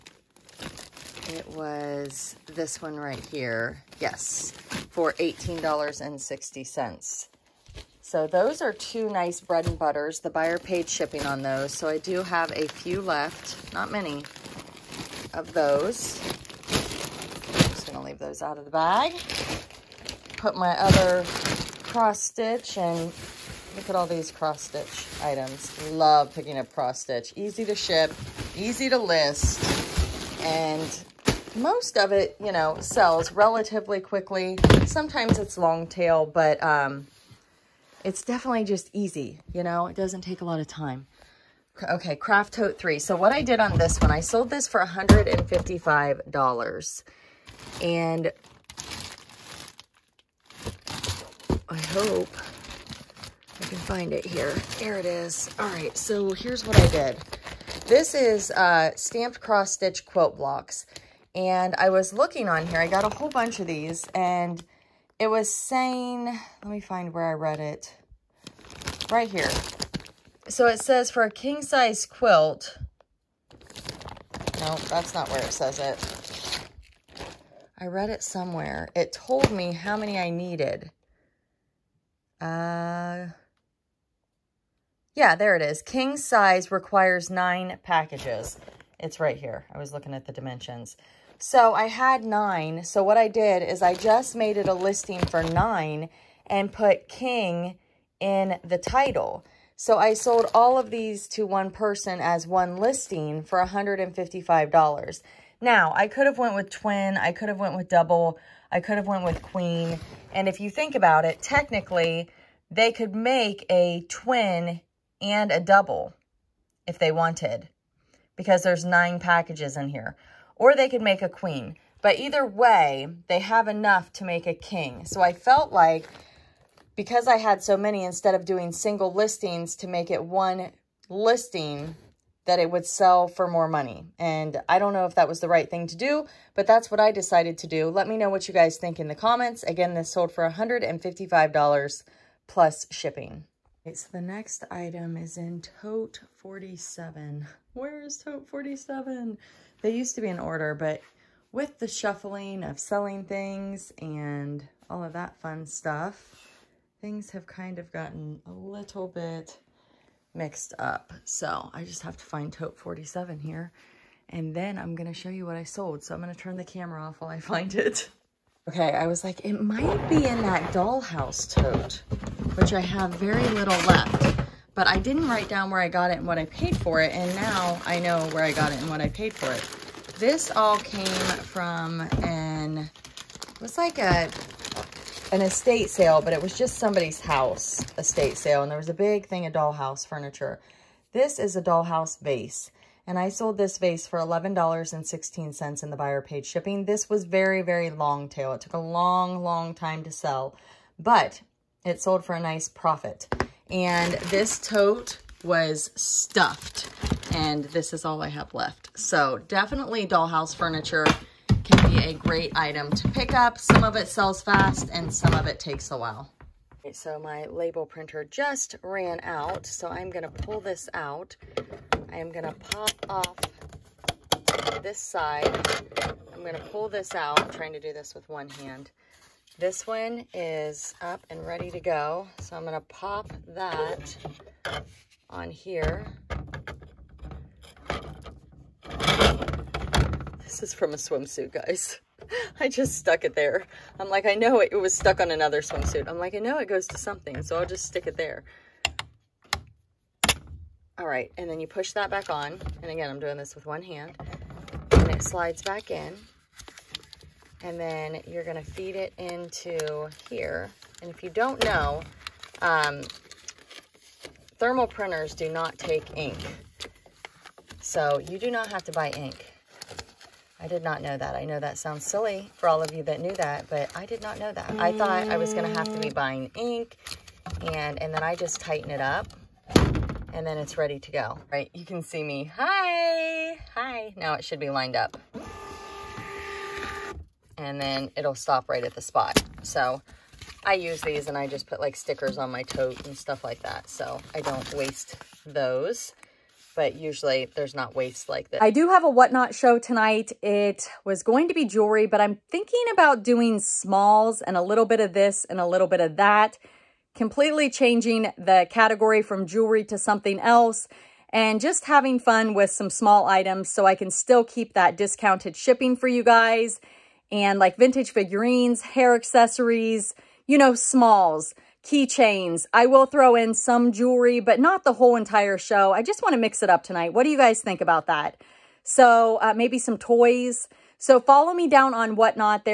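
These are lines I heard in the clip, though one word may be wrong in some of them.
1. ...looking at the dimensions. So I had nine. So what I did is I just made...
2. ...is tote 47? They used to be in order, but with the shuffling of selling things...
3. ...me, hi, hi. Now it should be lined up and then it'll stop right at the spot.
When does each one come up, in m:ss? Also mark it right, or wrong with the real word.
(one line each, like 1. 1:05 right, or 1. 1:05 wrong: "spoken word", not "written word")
1. 1:29 right
2. 2:28 right
3. 4:42 right.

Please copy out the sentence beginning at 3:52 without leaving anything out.
So I'm gonna pop that on here.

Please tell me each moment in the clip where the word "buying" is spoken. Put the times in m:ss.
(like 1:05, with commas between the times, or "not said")
4:36.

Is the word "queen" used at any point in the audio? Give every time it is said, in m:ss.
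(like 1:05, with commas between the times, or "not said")
1:49, 2:01.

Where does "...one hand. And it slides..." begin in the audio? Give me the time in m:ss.
4:13.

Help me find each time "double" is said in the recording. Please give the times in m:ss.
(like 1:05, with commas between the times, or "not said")
1:47, 1:55.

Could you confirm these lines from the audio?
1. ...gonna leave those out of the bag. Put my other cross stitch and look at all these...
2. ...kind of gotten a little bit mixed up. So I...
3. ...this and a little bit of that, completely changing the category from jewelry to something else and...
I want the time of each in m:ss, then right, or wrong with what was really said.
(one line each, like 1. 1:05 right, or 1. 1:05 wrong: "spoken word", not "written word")
1. 0:17 right
2. 2:37 right
3. 5:05 right.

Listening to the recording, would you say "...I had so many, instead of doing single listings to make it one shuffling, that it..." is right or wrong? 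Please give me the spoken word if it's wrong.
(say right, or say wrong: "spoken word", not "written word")
wrong: "listing", not "shuffling".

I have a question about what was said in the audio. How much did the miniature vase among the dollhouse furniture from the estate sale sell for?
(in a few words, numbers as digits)
$11.16.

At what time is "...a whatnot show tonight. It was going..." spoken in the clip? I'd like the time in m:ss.
4:59.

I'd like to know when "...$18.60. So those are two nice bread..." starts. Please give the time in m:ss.
0:05.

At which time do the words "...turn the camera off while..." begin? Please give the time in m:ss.
2:46.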